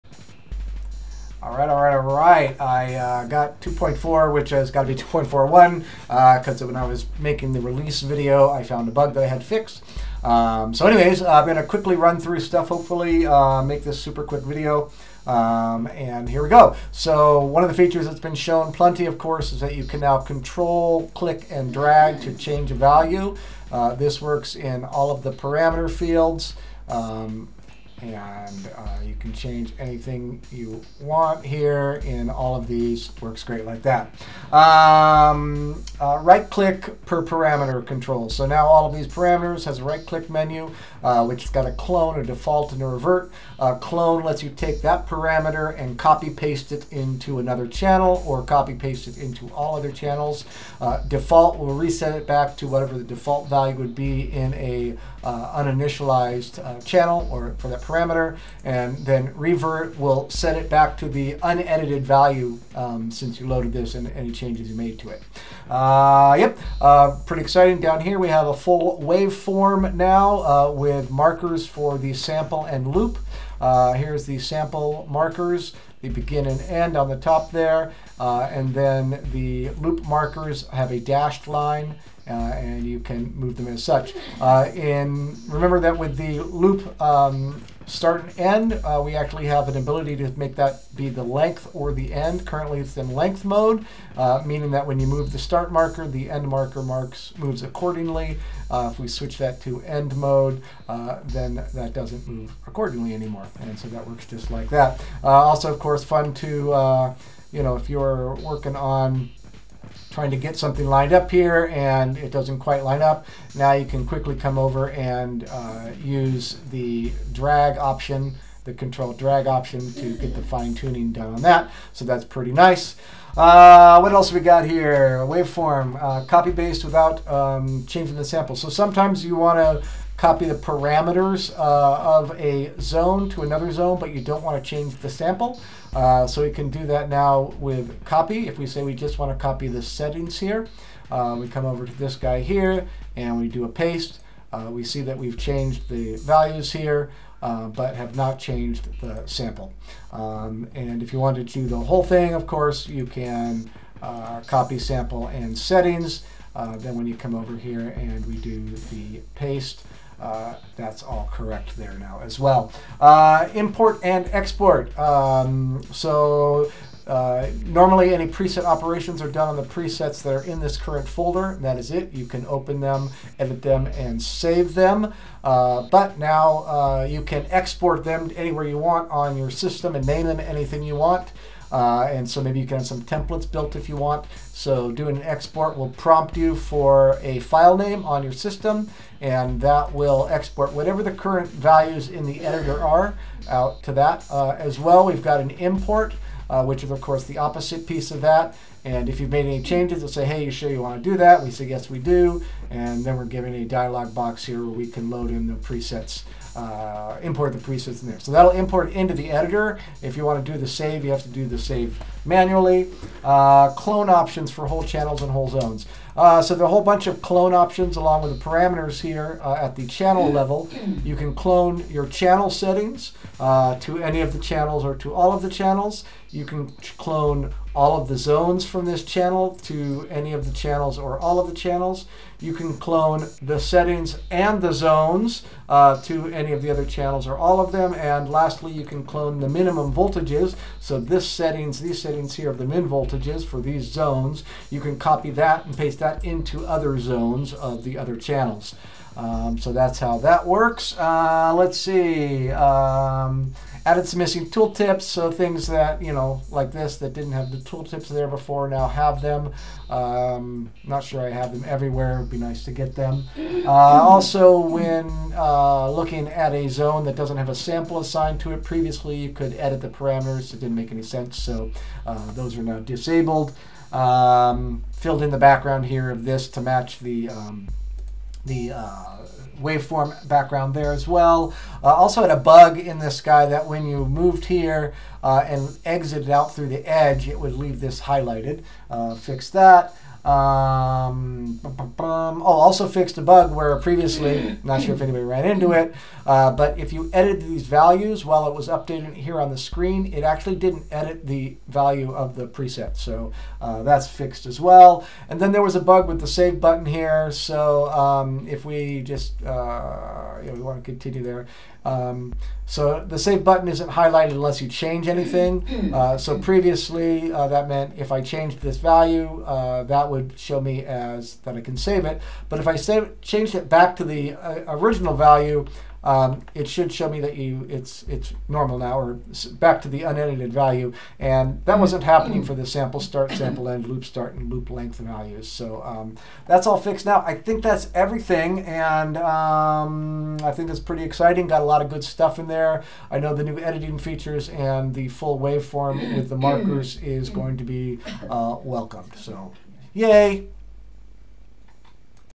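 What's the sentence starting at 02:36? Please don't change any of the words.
then when you come over here and we do the paste, uh, that's all correct there now as well.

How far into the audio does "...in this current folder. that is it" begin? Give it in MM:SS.
02:50.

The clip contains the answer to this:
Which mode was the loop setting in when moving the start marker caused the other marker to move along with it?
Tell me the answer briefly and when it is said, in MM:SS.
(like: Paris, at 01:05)
length mode, at 01:33.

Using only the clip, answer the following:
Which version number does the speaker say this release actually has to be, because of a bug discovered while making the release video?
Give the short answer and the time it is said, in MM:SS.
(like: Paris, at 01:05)
2.41, at 00:05.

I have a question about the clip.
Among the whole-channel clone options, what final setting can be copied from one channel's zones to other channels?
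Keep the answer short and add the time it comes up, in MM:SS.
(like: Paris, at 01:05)
minimum voltages, at 03:59.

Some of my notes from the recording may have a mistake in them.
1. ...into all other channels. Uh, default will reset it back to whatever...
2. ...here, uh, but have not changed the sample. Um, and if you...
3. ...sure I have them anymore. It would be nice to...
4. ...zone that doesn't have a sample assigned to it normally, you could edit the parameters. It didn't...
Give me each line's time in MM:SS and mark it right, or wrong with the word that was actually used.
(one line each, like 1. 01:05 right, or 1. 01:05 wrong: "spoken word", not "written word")
1. 00:49 right
2. 02:26 right
3. 04:21 wrong: "everywhere", not "anymore"
4. 04:26 wrong: "previously", not "normally".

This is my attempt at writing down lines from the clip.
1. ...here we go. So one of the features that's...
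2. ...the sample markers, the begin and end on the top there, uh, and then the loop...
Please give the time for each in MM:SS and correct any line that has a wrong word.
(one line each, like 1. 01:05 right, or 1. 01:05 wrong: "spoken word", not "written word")
1. 00:16 right
2. 01:14 right.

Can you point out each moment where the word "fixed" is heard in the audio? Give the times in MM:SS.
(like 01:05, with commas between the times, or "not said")
00:09, 04:52, 05:04, 05:36.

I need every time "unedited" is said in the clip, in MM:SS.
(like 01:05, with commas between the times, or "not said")
01:01, 05:30.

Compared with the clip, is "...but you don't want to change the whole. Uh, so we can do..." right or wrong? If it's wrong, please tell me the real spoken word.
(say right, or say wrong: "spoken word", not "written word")
wrong: "sample", not "whole".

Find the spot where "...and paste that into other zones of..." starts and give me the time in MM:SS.
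04:05.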